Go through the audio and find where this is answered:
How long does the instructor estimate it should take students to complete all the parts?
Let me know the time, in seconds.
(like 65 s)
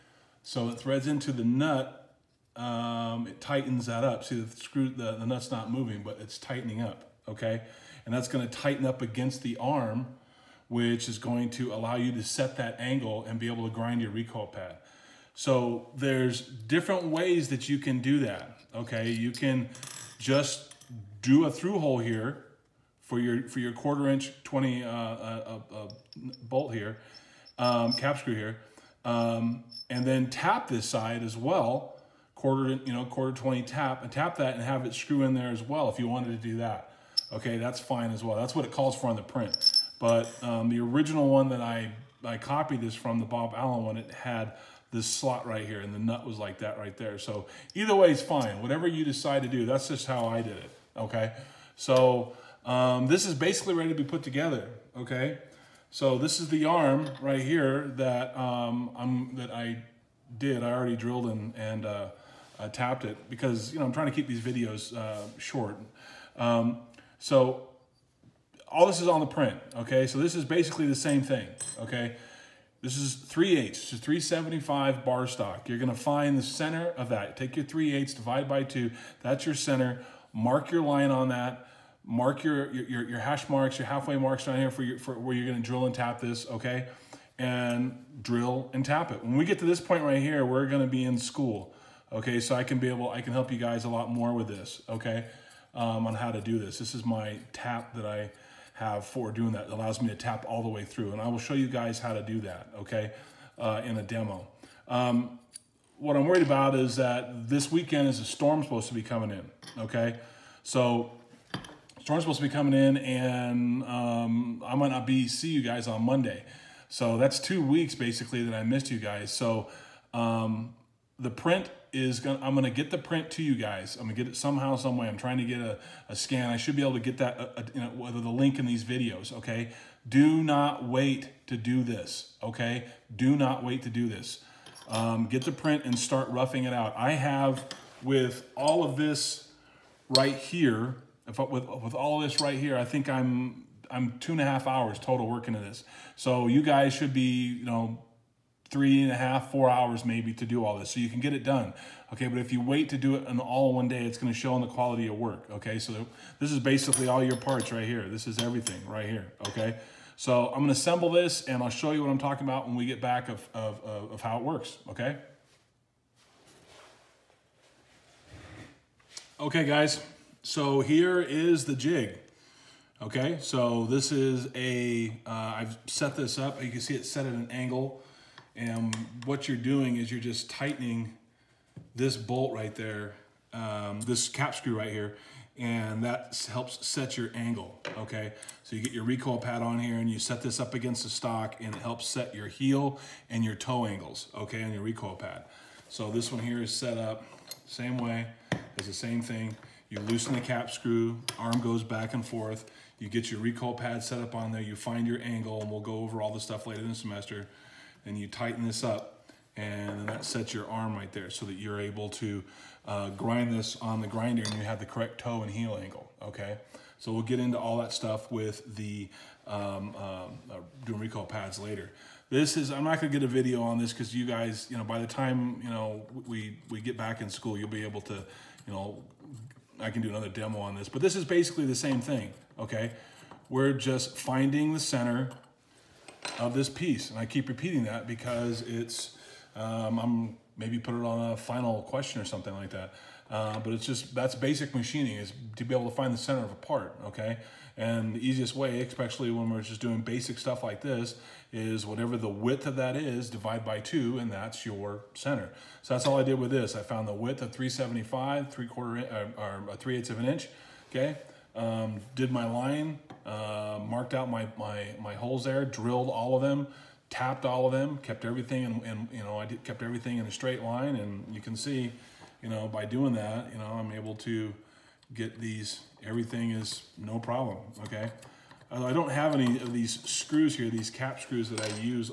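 148 s.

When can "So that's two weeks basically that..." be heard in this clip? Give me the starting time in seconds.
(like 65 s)
116 s.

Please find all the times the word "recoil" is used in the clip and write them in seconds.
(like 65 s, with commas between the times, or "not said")
14 s, 189 s, 194 s, 203 s, 220 s.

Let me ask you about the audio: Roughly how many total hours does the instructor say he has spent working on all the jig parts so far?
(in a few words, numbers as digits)
2.5 hours.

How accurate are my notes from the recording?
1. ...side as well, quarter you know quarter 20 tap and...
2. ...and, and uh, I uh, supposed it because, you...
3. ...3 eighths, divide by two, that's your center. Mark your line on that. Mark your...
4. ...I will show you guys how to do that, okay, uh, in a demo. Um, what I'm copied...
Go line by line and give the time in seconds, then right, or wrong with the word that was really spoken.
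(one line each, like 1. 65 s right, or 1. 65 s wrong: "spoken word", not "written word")
1. 30 s right
2. 61 s wrong: "tapped", not "supposed"
3. 77 s right
4. 101 s wrong: "worried", not "copied".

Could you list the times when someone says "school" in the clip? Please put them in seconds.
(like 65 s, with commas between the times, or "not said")
91 s, 227 s.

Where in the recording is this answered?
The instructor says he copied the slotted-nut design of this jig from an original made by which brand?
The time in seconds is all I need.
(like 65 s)
43 s.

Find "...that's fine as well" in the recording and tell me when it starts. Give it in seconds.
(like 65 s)
37 s.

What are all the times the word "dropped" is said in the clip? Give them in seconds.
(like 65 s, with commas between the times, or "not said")
not said.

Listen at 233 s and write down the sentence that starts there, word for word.
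We're just finding the center of this piece.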